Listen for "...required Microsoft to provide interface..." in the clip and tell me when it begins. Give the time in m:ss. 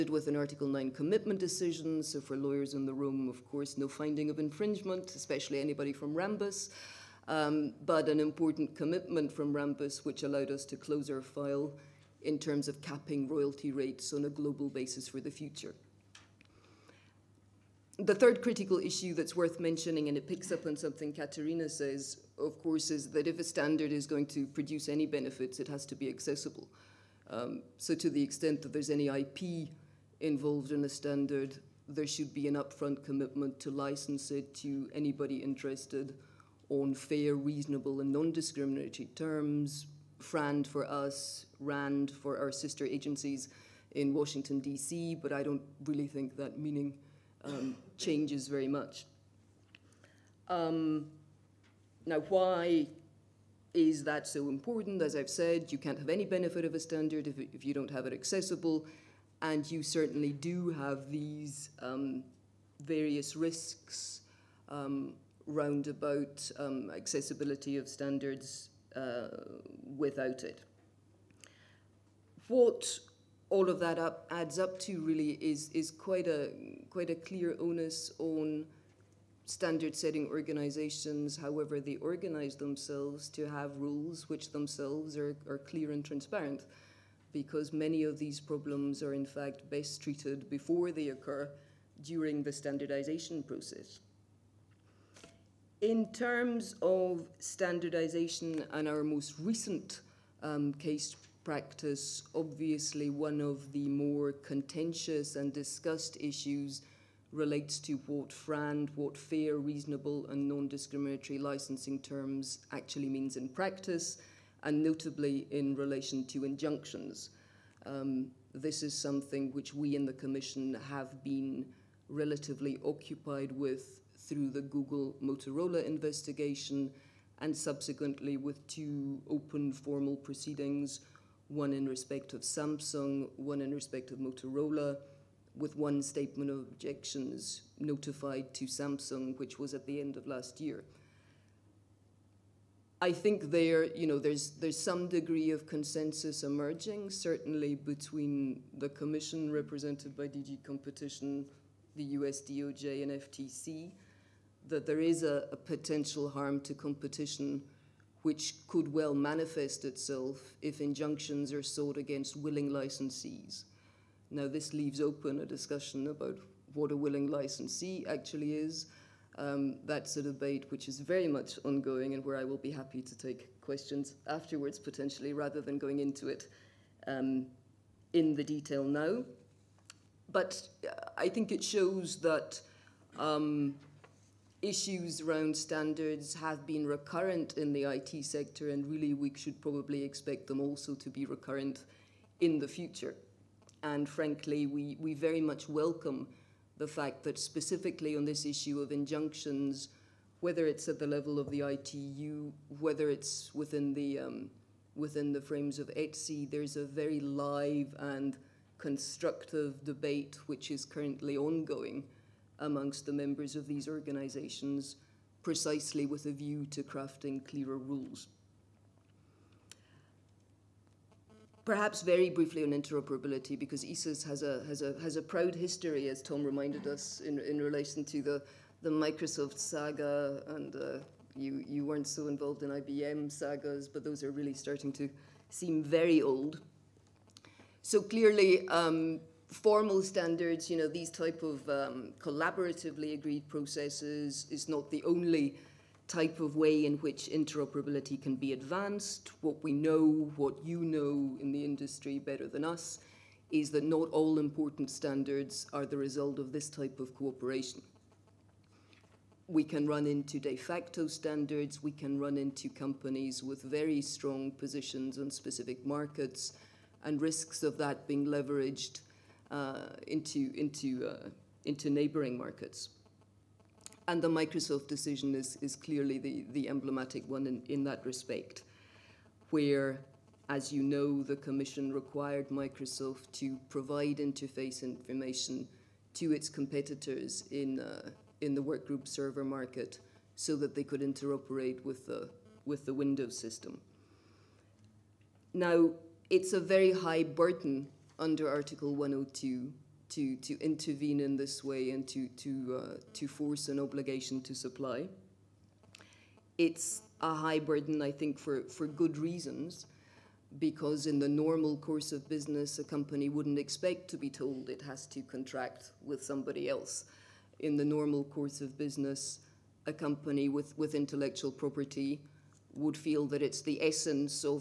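4:41.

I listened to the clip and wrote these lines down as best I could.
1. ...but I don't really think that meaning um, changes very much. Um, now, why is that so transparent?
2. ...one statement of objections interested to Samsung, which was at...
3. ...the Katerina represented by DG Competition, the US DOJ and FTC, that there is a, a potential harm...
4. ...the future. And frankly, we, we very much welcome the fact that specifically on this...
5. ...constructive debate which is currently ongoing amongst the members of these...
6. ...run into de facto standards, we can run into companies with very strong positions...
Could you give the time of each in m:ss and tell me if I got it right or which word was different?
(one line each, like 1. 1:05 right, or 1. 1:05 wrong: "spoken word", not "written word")
1. 0:45 wrong: "important", not "transparent"
2. 2:15 wrong: "notified", not "interested"
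3. 2:28 wrong: "Commission", not "Katerina"
4. 3:12 right
5. 3:28 right
6. 4:19 right.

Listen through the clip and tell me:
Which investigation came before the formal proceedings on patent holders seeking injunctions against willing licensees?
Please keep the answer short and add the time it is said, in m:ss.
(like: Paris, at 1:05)
Google Motorola, at 2:04.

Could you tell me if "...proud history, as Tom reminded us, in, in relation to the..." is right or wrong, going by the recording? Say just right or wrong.
right.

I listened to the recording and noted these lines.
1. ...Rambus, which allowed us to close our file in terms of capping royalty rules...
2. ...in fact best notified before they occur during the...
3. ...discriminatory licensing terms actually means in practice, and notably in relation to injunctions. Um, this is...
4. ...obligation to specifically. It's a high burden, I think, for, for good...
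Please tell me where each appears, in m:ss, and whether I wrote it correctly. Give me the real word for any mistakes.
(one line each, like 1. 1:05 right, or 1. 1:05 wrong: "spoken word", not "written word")
1. 0:09 wrong: "rates", not "rules"
2. 1:29 wrong: "treated", not "notified"
3. 1:50 right
4. 5:03 wrong: "supply", not "specifically".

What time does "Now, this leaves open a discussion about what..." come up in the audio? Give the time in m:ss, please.
2:44.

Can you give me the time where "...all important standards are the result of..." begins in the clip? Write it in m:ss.
4:14.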